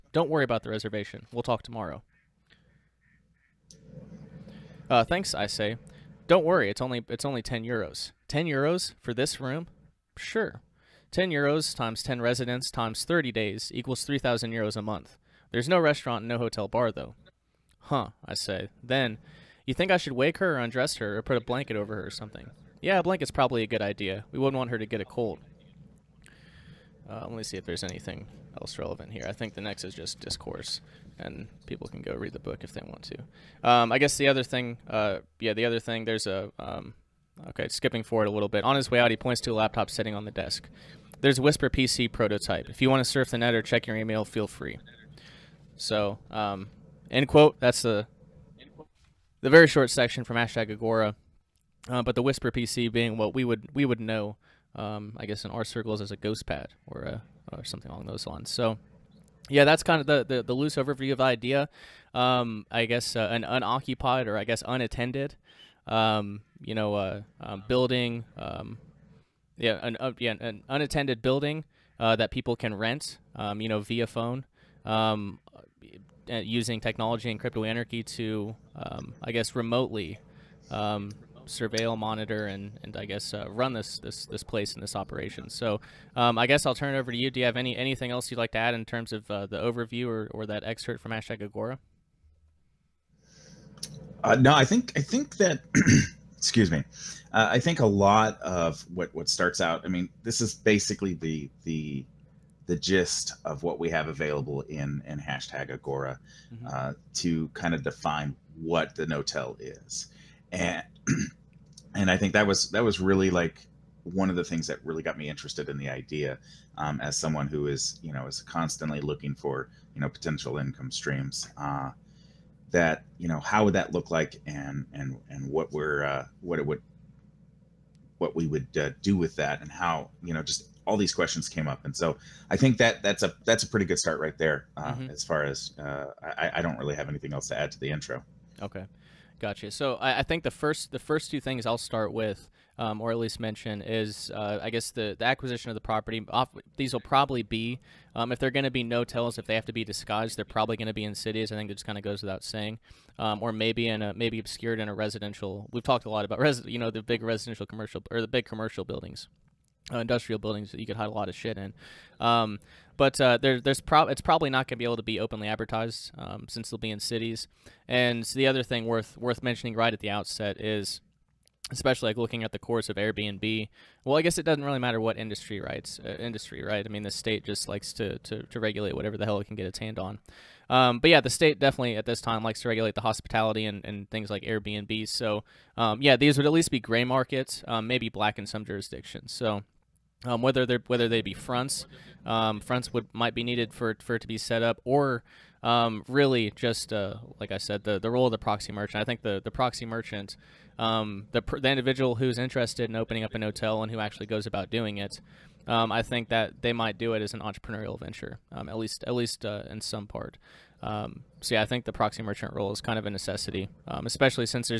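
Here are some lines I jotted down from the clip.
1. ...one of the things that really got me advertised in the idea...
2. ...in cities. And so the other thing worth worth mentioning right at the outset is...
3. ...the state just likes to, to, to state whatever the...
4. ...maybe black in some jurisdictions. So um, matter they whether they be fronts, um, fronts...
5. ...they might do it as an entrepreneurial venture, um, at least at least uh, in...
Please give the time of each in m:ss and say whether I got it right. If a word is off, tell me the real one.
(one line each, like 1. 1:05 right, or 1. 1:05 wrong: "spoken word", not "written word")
1. 1:54 wrong: "interested", not "advertised"
2. 2:46 right
3. 2:57 wrong: "regulate", not "state"
4. 3:07 wrong: "whether", not "matter"
5. 3:26 right.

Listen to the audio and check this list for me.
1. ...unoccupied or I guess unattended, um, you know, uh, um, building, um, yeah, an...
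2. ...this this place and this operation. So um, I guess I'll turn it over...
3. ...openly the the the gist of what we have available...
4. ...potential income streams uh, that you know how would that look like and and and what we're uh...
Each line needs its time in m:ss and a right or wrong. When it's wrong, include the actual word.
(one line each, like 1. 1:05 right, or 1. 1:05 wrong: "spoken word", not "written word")
1. 1:03 right
2. 1:23 right
3. 1:40 wrong: "basically", not "openly"
4. 2:00 right.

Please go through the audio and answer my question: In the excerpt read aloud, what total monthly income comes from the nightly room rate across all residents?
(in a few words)
3,000 euros.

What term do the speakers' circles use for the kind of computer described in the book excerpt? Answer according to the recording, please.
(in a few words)
ghost pad.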